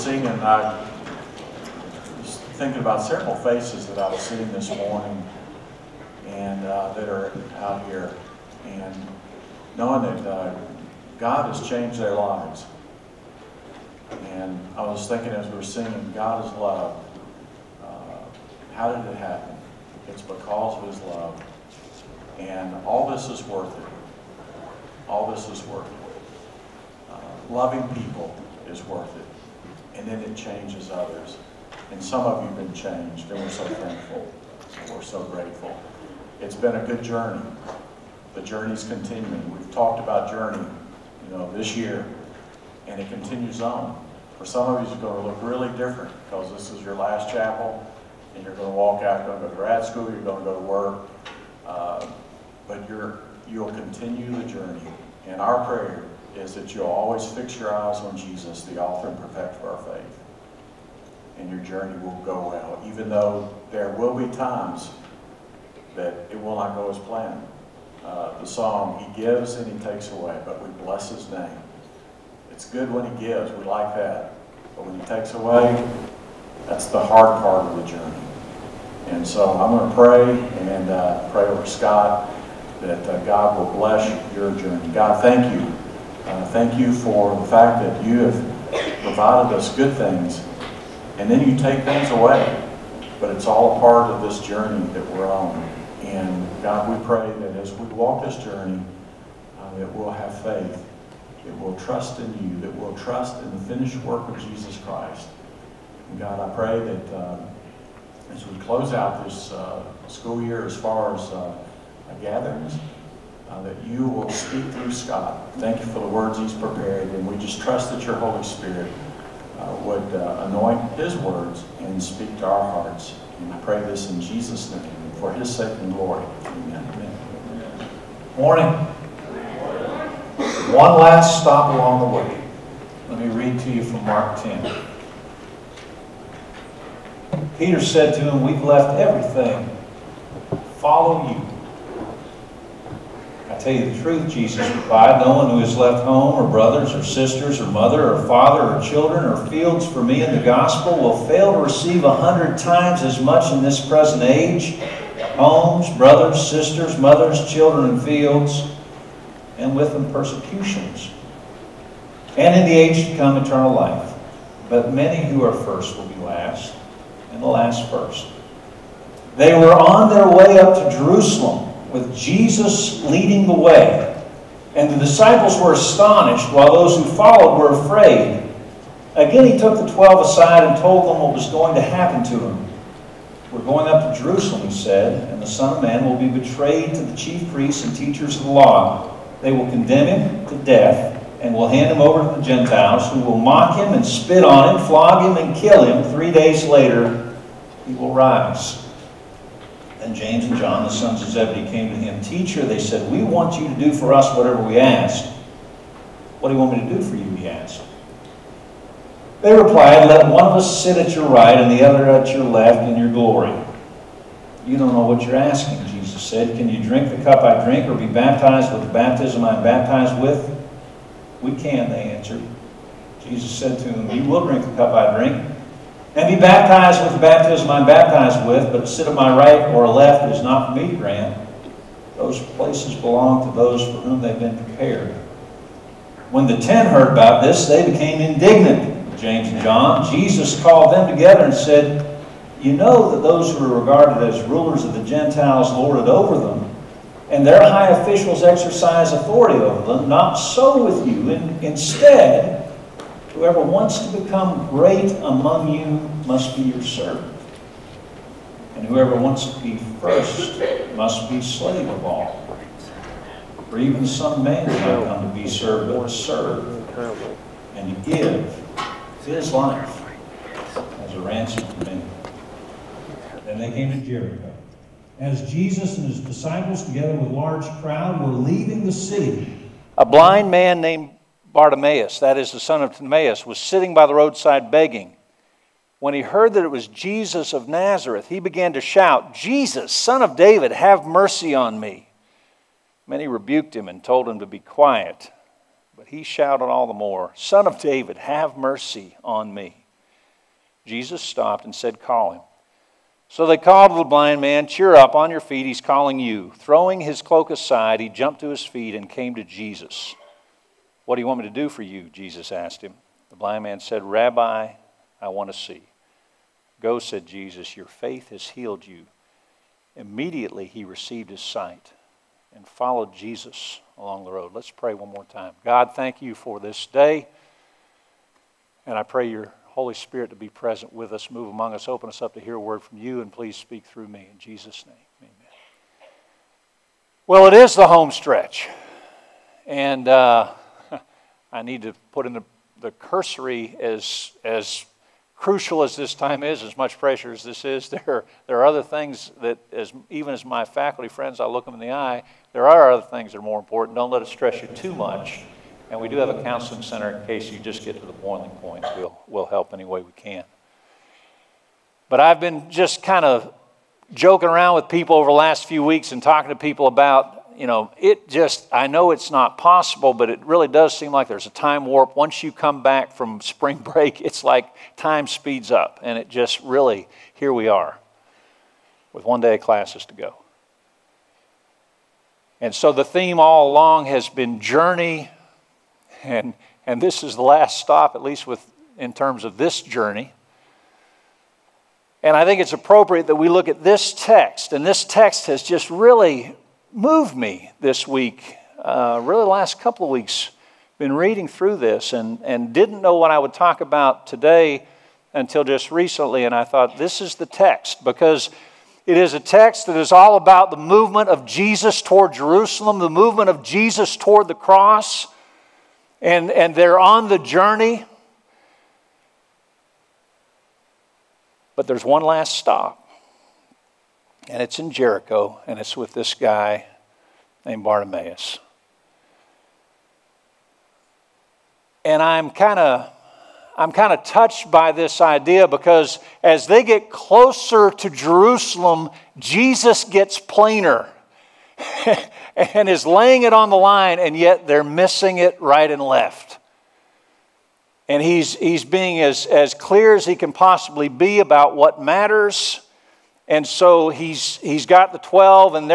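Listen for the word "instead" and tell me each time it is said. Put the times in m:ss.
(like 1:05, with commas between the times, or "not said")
4:11.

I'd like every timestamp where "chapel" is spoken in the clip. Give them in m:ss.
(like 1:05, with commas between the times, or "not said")
0:47.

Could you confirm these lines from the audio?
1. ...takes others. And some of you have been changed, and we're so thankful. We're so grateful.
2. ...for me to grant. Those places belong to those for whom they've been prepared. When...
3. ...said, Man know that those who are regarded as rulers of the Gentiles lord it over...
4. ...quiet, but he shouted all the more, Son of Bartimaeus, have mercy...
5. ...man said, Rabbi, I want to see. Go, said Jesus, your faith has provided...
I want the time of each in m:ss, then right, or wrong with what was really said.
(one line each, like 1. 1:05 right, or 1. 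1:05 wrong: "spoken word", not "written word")
1. 0:30 wrong: "changes", not "takes"
2. 3:50 right
3. 4:01 wrong: "You", not "Man"
4. 4:54 wrong: "David", not "Bartimaeus"
5. 5:13 wrong: "healed", not "provided".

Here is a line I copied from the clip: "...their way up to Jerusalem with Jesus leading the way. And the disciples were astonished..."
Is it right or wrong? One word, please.
right.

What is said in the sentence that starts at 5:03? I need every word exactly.
So they called the blind man, Cheer up, on your feet, he's calling you.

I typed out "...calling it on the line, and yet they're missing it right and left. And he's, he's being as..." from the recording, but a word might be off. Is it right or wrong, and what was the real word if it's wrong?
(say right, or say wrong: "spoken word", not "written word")
wrong: "laying", not "calling".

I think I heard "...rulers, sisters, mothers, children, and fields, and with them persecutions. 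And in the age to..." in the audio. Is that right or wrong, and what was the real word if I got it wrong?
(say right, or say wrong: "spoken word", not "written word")
wrong: "brothers", not "rulers".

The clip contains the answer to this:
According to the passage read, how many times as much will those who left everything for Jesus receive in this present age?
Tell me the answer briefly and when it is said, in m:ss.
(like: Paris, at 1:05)
100, at 2:32.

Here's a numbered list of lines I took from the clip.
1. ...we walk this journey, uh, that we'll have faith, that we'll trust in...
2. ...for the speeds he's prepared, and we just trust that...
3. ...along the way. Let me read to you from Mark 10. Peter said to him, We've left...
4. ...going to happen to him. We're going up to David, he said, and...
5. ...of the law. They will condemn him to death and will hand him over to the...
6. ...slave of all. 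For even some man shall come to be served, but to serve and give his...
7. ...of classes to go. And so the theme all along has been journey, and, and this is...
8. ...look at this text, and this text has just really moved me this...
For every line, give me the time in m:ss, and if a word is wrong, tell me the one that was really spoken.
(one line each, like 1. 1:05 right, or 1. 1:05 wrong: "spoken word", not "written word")
1. 1:37 right
2. 1:55 wrong: "words", not "speeds"
3. 2:11 right
4. 3:01 wrong: "Jerusalem", not "David"
5. 3:08 right
6. 4:21 right
7. 6:19 right
8. 6:33 right.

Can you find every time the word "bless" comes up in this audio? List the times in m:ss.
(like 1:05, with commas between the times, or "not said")
1:10, 1:23.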